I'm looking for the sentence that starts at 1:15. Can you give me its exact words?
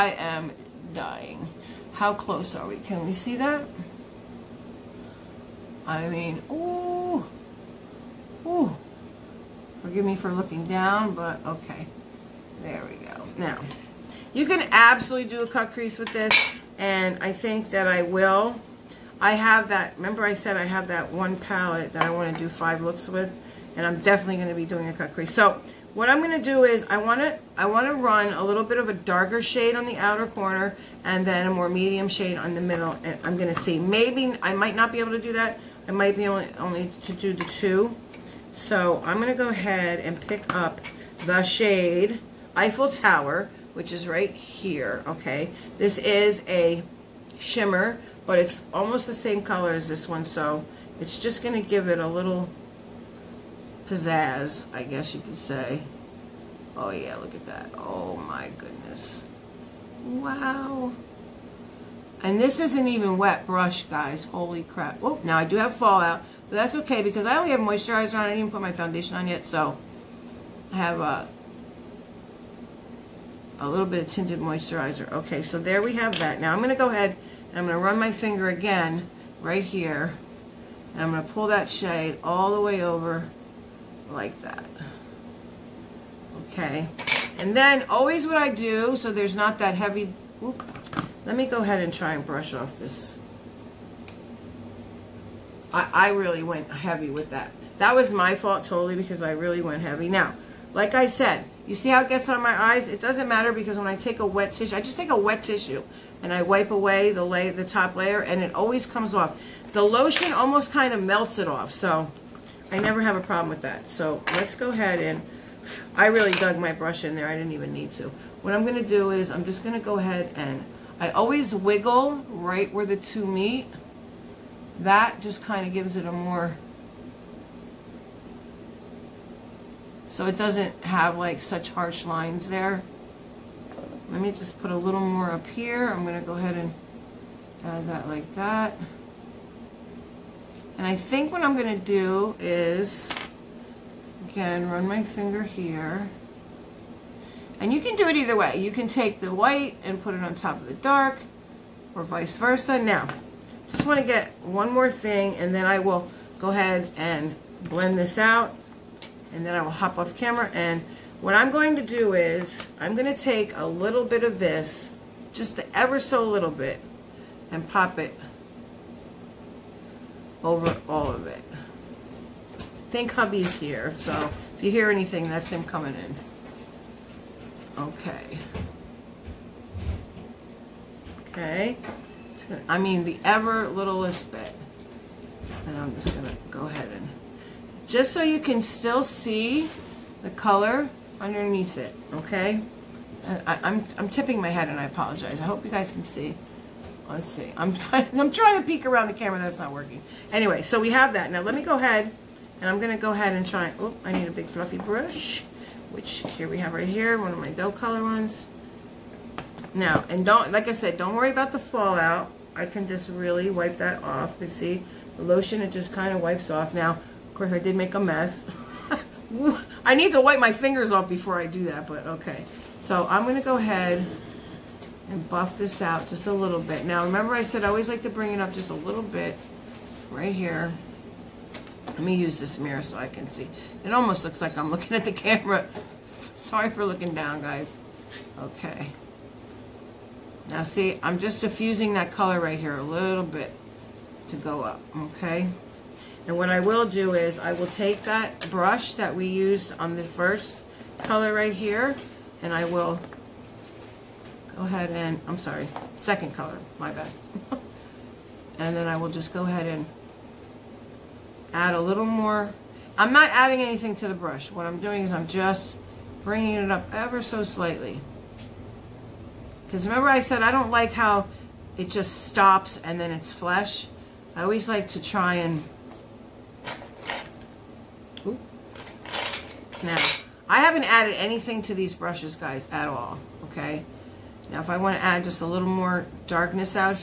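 Okay, so there we have that.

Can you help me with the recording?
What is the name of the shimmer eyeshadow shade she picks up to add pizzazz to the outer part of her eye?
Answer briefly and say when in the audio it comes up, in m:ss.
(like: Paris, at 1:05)
Eiffel Tower, at 0:42.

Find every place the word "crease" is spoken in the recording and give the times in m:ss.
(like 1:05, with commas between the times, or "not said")
0:15, 0:25.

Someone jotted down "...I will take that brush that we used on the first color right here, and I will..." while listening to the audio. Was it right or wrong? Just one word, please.
right.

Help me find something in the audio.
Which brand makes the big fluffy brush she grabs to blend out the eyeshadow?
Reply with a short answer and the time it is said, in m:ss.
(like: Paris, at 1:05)
Docolor, at 3:27.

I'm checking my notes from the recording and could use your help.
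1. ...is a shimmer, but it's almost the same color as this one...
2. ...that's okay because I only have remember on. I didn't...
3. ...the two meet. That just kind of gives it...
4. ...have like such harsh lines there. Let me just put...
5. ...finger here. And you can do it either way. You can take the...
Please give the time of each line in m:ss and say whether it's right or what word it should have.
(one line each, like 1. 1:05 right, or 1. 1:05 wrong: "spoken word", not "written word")
1. 0:45 right
2. 1:06 wrong: "moisturizer", not "remember"
3. 2:02 right
4. 2:10 right
5. 2:25 right.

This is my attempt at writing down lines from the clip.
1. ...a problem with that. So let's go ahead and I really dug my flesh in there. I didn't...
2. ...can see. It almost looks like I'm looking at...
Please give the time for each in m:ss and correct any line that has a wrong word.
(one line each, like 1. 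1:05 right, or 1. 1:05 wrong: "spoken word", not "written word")
1. 1:53 wrong: "brush", not "flesh"
2. 3:53 right.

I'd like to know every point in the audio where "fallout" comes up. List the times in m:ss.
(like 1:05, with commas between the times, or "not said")
1:05, 3:31.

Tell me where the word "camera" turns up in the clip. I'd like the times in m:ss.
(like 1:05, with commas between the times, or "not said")
2:40, 3:19, 3:55.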